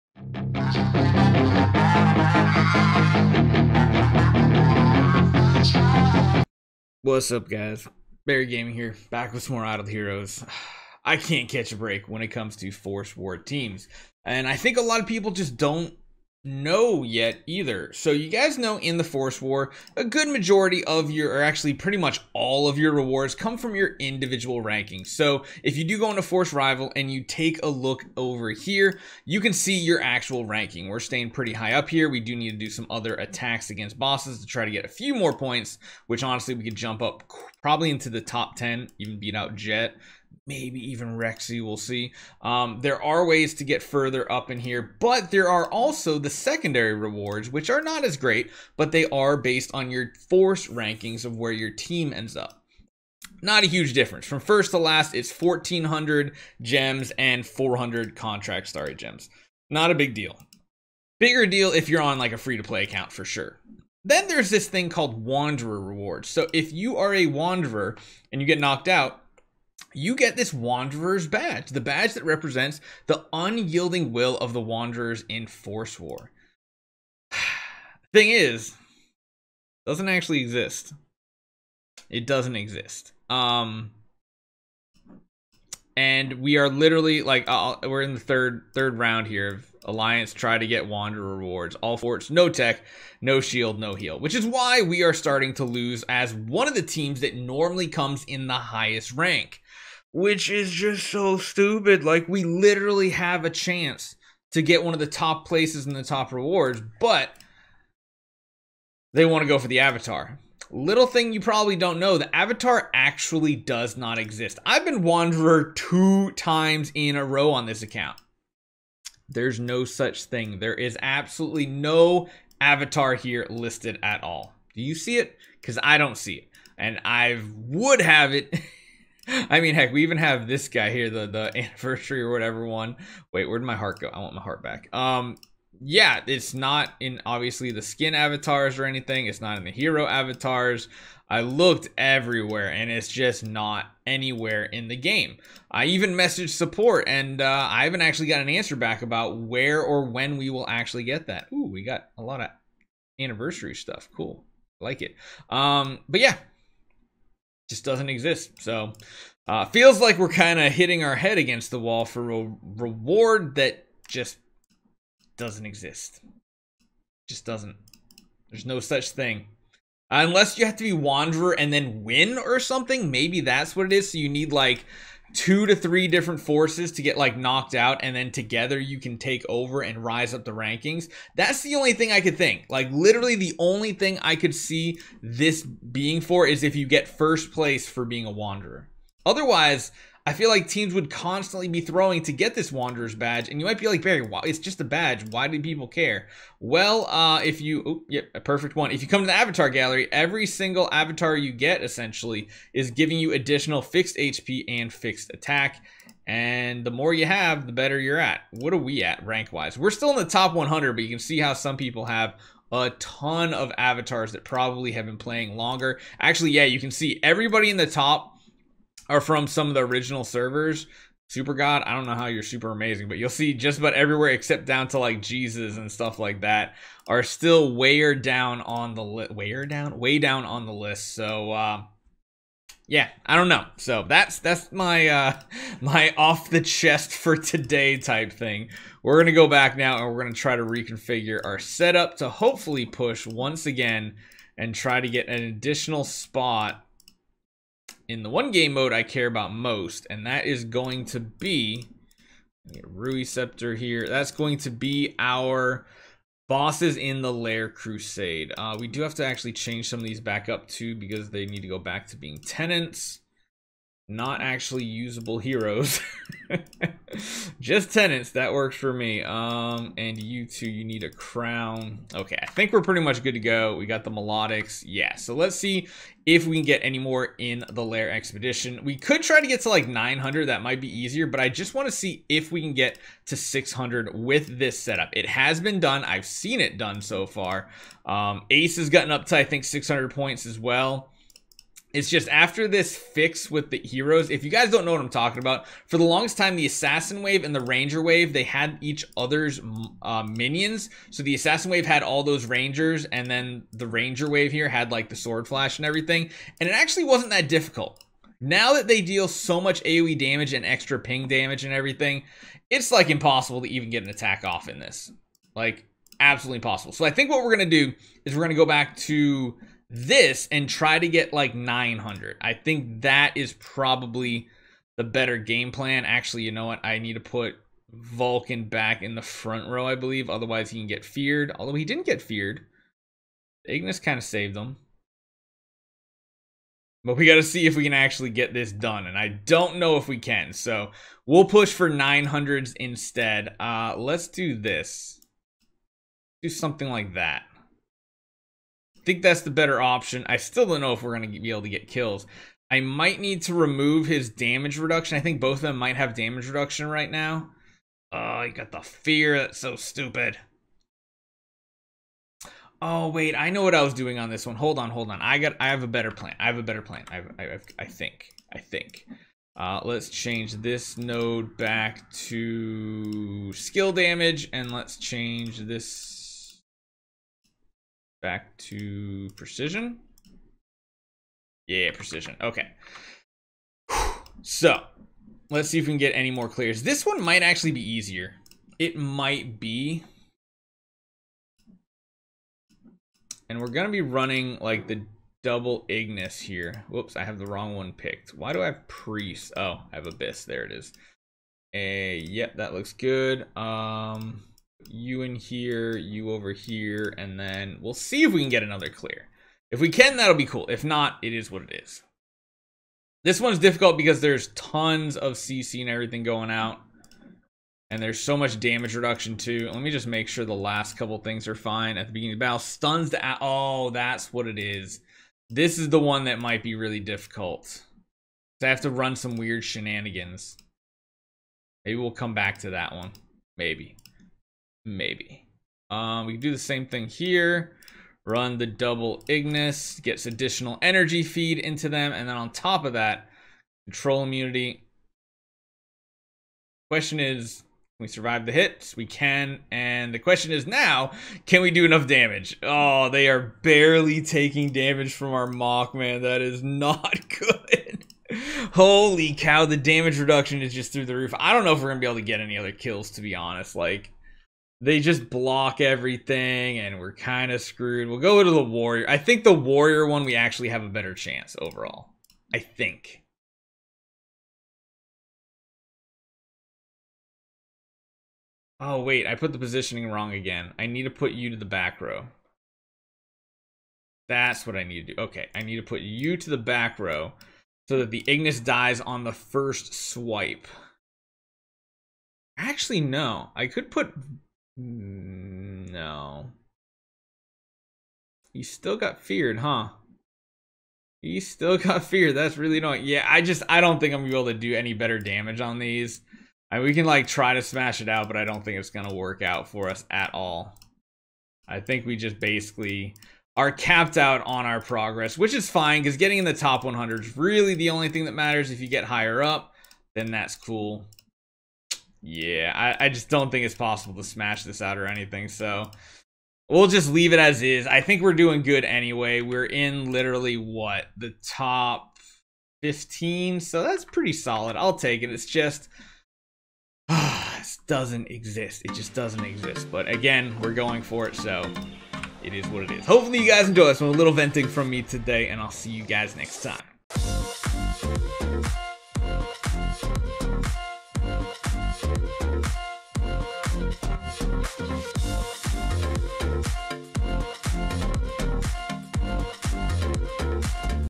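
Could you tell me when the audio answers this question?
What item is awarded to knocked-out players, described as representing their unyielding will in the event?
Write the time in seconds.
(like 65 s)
70 s.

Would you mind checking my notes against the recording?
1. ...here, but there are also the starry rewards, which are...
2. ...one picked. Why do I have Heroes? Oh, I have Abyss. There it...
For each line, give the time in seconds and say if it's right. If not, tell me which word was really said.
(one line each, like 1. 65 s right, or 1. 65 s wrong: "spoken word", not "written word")
1. 44 s wrong: "secondary", not "starry"
2. 397 s wrong: "Priest", not "Heroes".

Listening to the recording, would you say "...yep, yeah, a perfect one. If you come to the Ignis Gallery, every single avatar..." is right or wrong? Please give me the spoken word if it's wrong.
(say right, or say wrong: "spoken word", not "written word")
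wrong: "Avatar", not "Ignis".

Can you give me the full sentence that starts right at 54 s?
From first to last, it's 1,400 gems and 400 contract starry gems.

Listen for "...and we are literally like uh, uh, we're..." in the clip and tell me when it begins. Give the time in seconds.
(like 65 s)
85 s.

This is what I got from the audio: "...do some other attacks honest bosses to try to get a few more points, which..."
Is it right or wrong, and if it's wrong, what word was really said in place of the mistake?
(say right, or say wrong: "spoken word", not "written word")
wrong: "against", not "honest".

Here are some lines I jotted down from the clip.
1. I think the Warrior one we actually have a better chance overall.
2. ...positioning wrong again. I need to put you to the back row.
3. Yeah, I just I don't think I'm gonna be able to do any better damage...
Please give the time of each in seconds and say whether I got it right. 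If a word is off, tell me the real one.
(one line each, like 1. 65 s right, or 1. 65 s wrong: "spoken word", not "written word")
1. 469 s right
2. 479 s right
3. 503 s right.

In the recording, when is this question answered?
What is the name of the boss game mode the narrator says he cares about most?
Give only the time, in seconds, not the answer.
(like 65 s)
257 s.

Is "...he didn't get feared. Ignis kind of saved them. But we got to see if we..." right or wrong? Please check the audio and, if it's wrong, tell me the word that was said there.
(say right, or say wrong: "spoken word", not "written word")
right.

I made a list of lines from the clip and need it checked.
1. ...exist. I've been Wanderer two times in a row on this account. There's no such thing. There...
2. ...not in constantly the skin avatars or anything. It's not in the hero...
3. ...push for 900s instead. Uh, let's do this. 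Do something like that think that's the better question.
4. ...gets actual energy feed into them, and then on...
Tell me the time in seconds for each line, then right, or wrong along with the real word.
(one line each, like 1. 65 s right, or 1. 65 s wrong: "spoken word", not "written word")
1. 114 s right
2. 136 s wrong: "obviously", not "constantly"
3. 341 s wrong: "option", not "question"
4. 439 s wrong: "additional", not "actual".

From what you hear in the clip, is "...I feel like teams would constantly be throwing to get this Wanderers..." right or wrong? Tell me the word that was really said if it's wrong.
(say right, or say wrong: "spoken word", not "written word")
right.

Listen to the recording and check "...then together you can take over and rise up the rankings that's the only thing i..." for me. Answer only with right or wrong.
right.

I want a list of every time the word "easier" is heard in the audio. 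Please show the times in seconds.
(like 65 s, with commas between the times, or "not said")
280 s, 387 s.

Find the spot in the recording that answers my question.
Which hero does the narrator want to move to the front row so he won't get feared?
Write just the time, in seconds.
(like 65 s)
327 s.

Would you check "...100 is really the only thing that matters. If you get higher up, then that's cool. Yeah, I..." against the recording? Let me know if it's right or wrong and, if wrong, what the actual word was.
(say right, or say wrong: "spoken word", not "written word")
right.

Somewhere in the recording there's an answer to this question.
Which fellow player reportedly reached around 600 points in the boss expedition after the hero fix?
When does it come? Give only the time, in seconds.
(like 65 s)
288 s.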